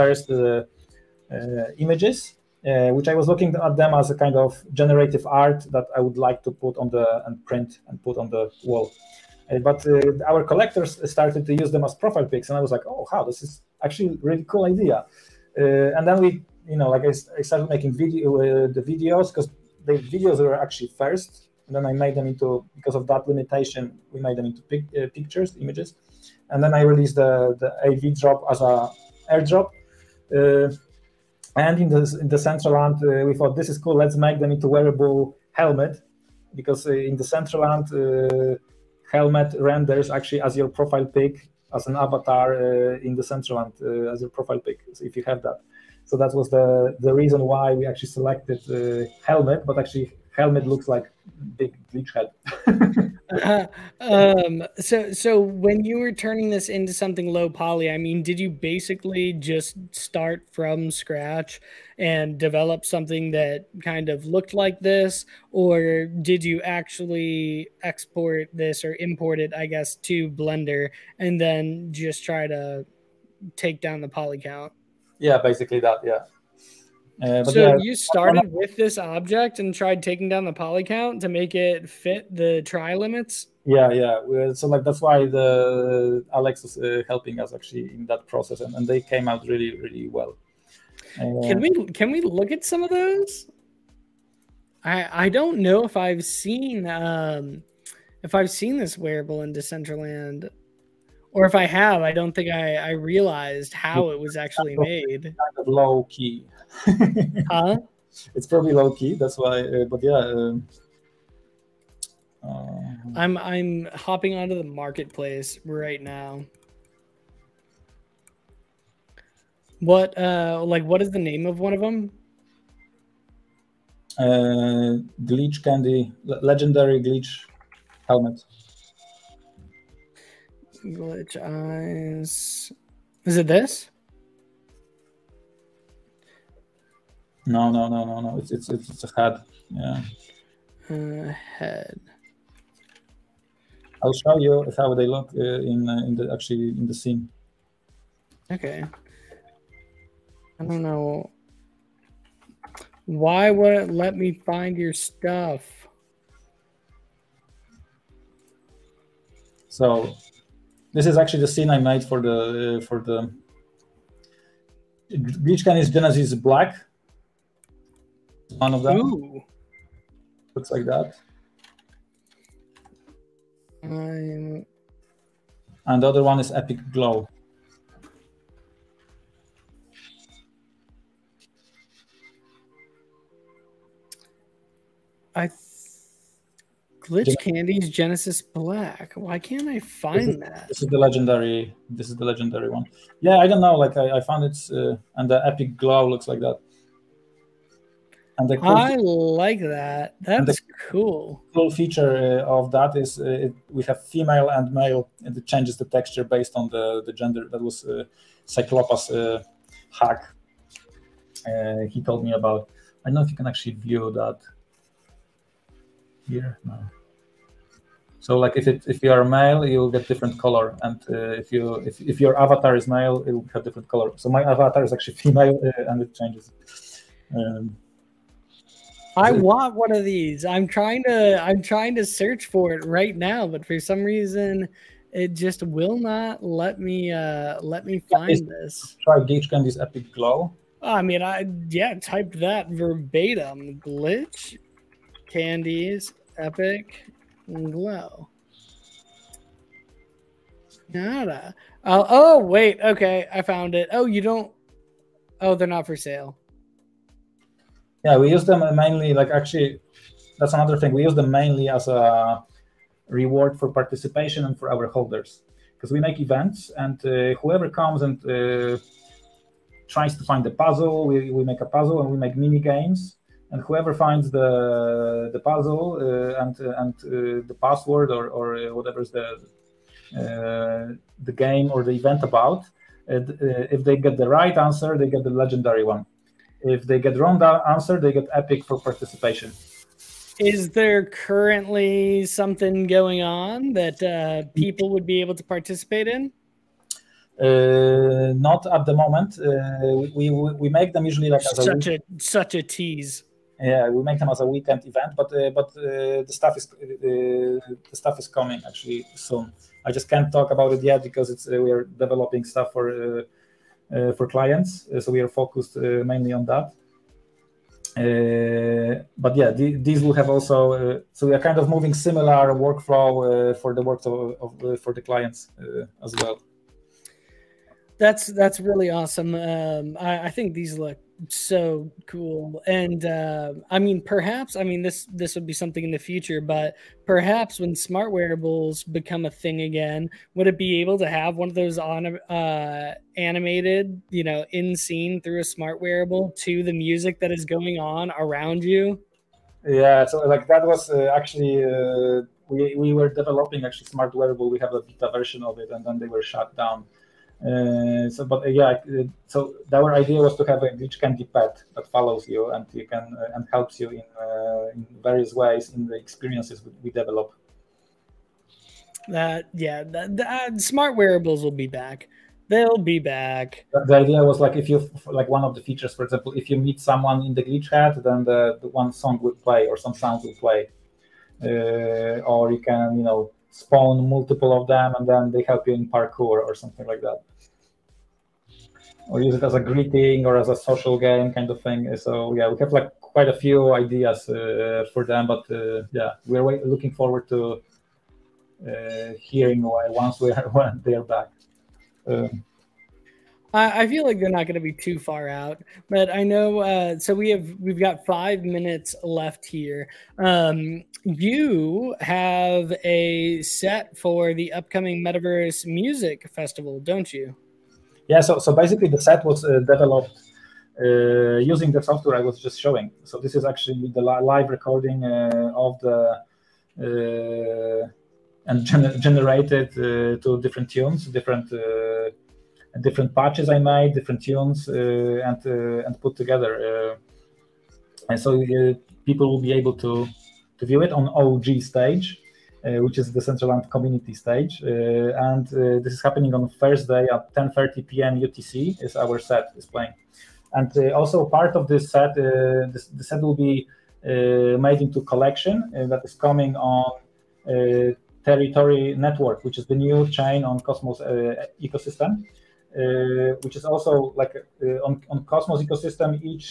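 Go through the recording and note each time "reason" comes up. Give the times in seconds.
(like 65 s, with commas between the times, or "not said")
47 s, 234 s.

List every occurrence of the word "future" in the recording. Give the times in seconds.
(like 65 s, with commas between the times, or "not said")
335 s.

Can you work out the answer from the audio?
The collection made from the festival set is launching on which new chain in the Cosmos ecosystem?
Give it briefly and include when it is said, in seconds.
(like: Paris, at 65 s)
Teritori Network, at 458 s.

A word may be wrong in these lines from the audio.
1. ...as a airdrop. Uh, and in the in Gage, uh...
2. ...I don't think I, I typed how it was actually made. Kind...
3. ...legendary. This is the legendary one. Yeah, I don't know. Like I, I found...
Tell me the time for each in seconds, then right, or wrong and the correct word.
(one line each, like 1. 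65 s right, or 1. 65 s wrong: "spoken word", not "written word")
1. 28 s wrong: "Decentraland", not "Gage"
2. 102 s wrong: "realized", not "typed"
3. 190 s right.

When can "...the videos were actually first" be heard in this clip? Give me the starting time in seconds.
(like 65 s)
19 s.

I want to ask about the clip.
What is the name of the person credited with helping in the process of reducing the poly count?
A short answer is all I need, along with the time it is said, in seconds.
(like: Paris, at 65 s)
Alex, at 86 s.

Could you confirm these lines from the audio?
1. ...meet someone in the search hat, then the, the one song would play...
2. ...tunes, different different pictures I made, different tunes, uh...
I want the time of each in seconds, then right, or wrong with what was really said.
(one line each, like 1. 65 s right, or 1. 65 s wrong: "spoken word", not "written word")
1. 376 s wrong: "glitch", not "search"
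2. 430 s wrong: "patches", not "pictures".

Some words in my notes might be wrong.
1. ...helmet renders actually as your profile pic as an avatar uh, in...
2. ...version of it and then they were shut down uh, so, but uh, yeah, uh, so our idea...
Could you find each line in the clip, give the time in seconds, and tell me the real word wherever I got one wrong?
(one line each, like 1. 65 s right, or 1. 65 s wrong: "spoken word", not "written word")
1. 39 s right
2. 355 s right.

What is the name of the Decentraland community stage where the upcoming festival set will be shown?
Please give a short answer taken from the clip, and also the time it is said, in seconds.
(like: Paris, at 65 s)
OG stage, at 441 s.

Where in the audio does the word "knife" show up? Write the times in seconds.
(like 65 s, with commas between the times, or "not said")
not said.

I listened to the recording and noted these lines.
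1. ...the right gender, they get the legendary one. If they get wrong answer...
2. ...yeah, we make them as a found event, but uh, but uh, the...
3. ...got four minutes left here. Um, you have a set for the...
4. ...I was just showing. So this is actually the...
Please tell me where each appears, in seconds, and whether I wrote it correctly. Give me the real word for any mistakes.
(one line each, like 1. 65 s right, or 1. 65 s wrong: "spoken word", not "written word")
1. 284 s wrong: "answer", not "gender"
2. 303 s wrong: "weekend", not "found"
3. 407 s wrong: "five", not "four"
4. 422 s right.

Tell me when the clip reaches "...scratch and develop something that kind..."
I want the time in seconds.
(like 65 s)
60 s.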